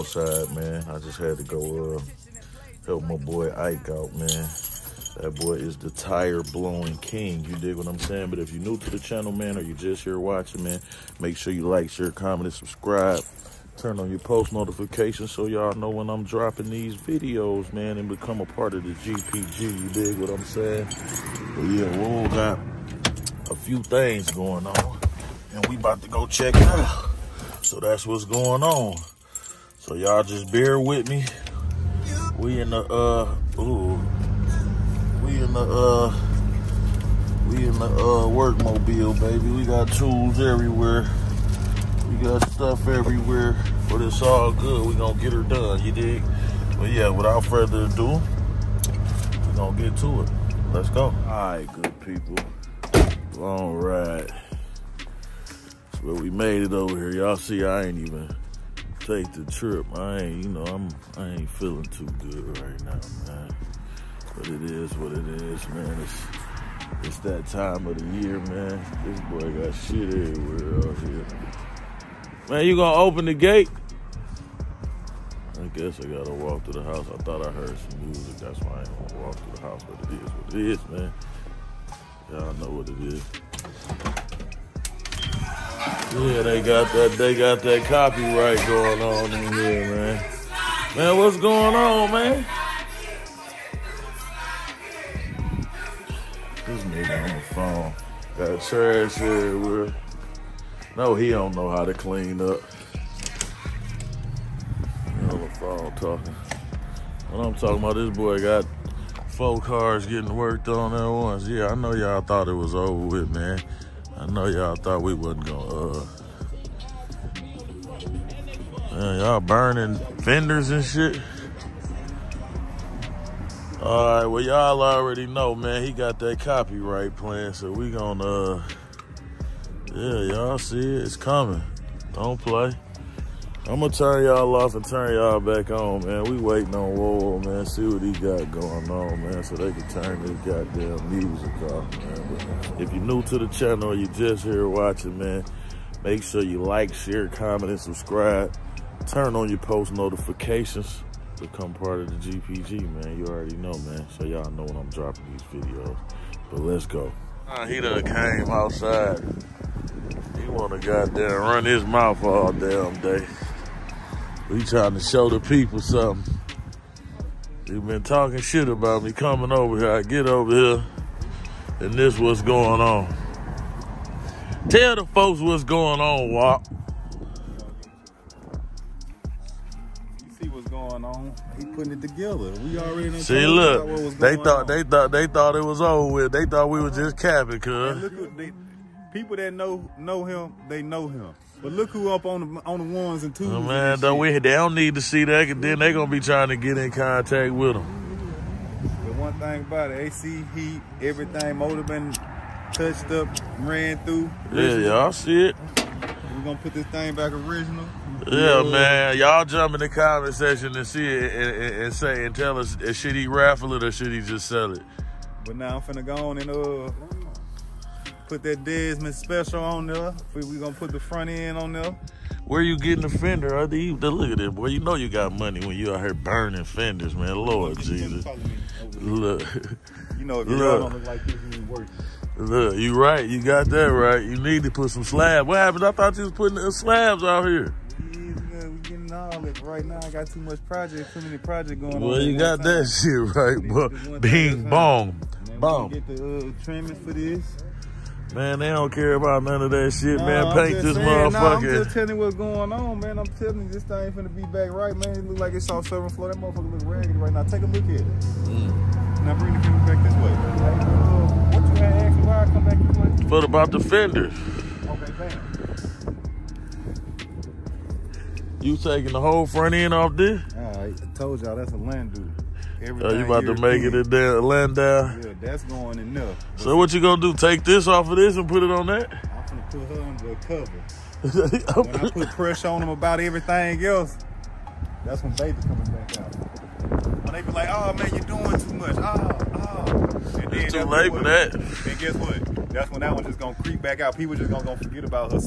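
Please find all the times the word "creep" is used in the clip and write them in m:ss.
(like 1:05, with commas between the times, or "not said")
4:53.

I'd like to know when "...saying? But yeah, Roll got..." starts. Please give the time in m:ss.
0:20.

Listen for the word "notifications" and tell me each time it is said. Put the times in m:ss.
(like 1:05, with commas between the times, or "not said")
0:14, 2:29.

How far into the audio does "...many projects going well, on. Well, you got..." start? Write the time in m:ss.
4:01.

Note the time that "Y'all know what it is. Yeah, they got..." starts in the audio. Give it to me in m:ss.
1:22.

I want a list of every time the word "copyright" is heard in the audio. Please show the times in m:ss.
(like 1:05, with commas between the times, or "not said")
1:27, 2:06.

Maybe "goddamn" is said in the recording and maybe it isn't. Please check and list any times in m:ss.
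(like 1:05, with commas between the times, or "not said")
2:20, 2:40.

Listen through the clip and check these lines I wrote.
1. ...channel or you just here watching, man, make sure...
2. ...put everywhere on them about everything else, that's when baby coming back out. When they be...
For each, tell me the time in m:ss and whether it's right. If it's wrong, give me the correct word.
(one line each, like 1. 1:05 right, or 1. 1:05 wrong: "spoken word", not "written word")
1. 2:23 right
2. 4:42 wrong: "pressure", not "everywhere".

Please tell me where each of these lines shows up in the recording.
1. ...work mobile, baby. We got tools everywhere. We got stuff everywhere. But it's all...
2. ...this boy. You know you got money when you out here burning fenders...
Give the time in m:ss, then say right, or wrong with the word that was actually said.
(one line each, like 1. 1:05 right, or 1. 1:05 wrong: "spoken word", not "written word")
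1. 0:38 right
2. 3:44 right.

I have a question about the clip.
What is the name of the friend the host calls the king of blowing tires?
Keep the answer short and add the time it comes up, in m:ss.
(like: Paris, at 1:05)
Ike, at 0:03.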